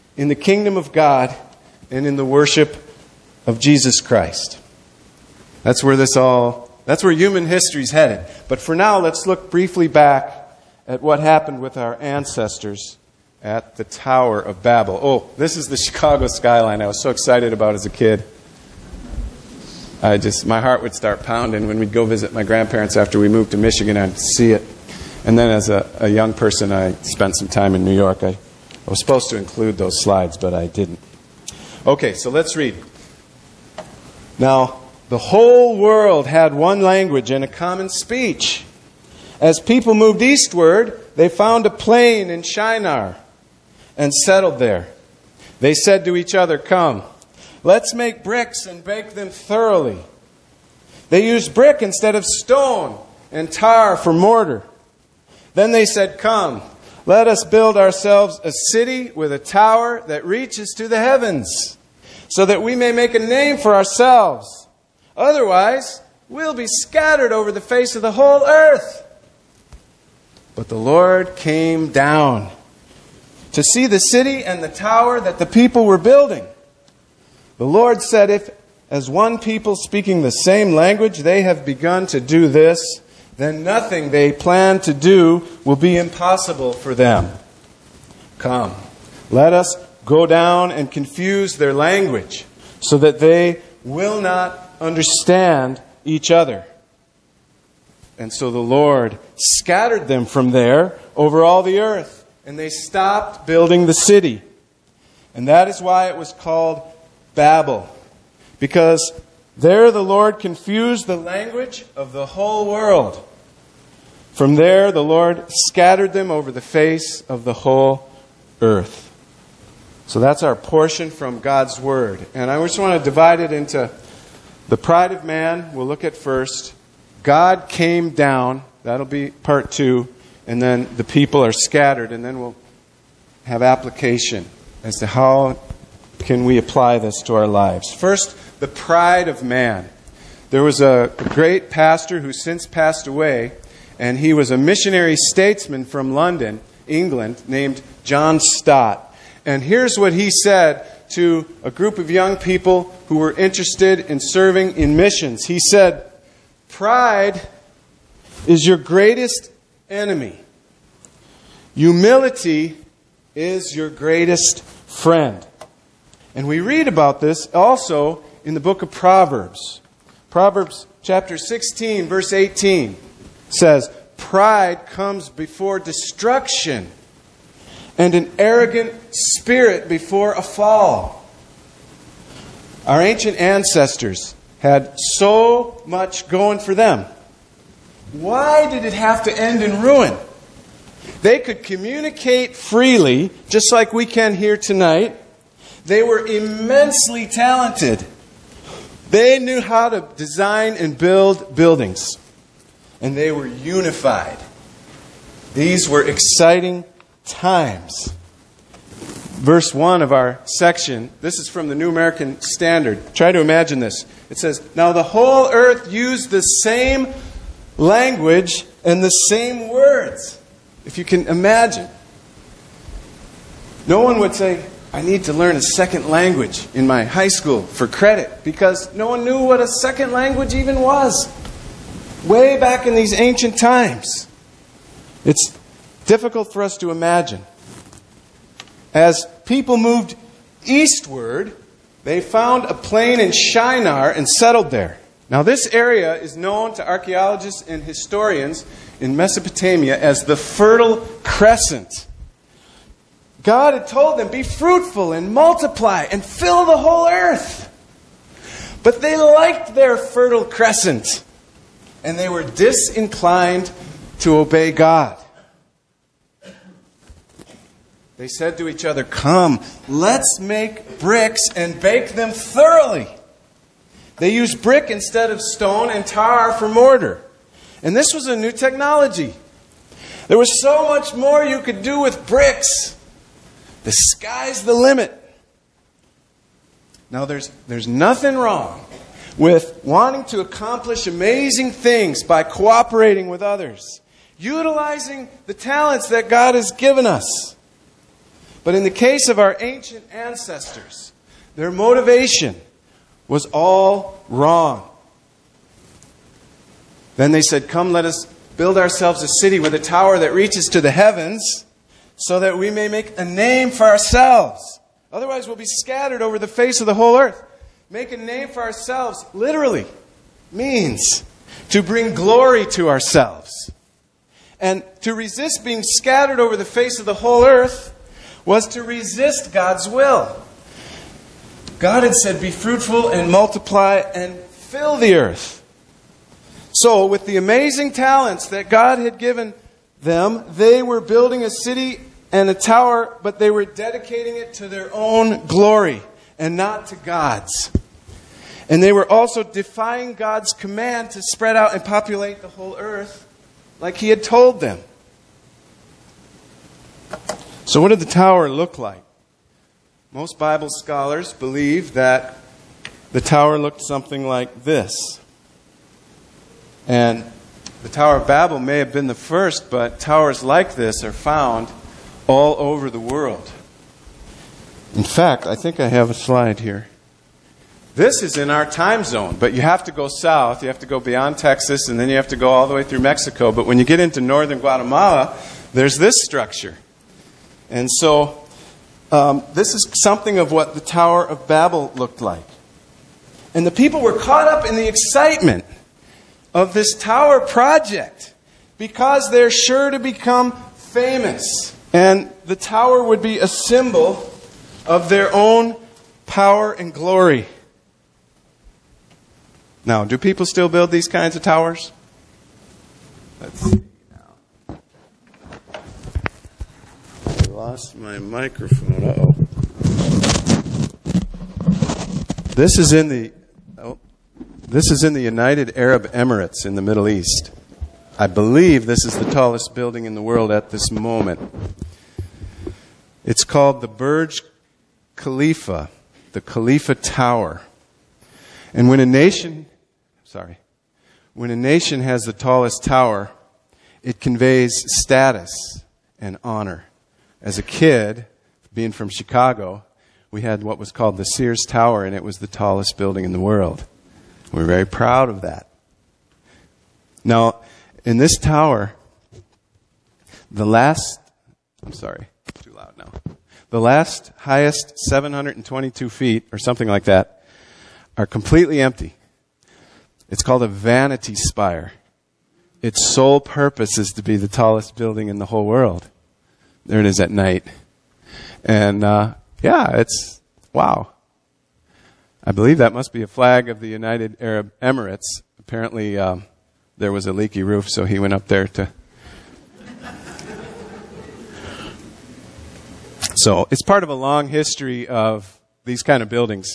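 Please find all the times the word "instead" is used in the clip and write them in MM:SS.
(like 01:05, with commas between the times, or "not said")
00:51, 04:34.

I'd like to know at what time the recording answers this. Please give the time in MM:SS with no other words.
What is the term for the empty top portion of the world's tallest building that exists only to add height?
07:50.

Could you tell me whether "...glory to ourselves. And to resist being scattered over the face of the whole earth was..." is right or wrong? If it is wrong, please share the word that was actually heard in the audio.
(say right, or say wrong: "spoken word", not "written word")
right.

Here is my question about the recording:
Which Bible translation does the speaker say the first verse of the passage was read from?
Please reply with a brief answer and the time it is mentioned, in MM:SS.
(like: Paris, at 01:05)
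New American Standard, at 03:31.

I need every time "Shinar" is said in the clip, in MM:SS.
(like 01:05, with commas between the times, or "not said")
00:42, 04:03.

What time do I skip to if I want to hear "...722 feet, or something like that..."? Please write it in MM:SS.
07:45.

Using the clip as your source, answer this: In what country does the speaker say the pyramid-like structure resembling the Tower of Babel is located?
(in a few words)
Guatemala.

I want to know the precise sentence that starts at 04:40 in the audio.
There was so much more you could do with bricks.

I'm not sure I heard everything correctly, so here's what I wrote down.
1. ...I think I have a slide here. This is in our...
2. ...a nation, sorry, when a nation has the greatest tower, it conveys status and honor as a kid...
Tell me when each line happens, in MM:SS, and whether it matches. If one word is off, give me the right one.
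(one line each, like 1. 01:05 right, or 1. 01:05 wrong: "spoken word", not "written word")
1. 06:15 right
2. 07:18 wrong: "tallest", not "greatest".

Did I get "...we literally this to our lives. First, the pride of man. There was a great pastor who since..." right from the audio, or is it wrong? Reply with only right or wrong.
wrong.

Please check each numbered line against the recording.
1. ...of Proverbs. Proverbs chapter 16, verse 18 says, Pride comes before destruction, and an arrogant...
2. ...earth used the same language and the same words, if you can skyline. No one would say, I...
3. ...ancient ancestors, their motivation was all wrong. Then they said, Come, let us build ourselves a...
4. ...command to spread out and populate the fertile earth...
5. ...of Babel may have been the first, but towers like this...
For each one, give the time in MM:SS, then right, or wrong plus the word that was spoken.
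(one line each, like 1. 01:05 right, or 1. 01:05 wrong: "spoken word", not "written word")
1. 02:48 right
2. 03:35 wrong: "imagine", not "skyline"
3. 04:59 right
4. 05:50 wrong: "whole", not "fertile"
5. 06:08 right.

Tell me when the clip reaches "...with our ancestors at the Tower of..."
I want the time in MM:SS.
00:11.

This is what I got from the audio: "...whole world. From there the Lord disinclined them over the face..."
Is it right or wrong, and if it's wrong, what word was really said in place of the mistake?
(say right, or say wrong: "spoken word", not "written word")
wrong: "scattered", not "disinclined".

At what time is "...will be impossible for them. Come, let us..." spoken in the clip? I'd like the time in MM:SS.
01:25.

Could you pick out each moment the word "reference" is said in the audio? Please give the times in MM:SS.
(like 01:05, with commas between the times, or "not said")
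not said.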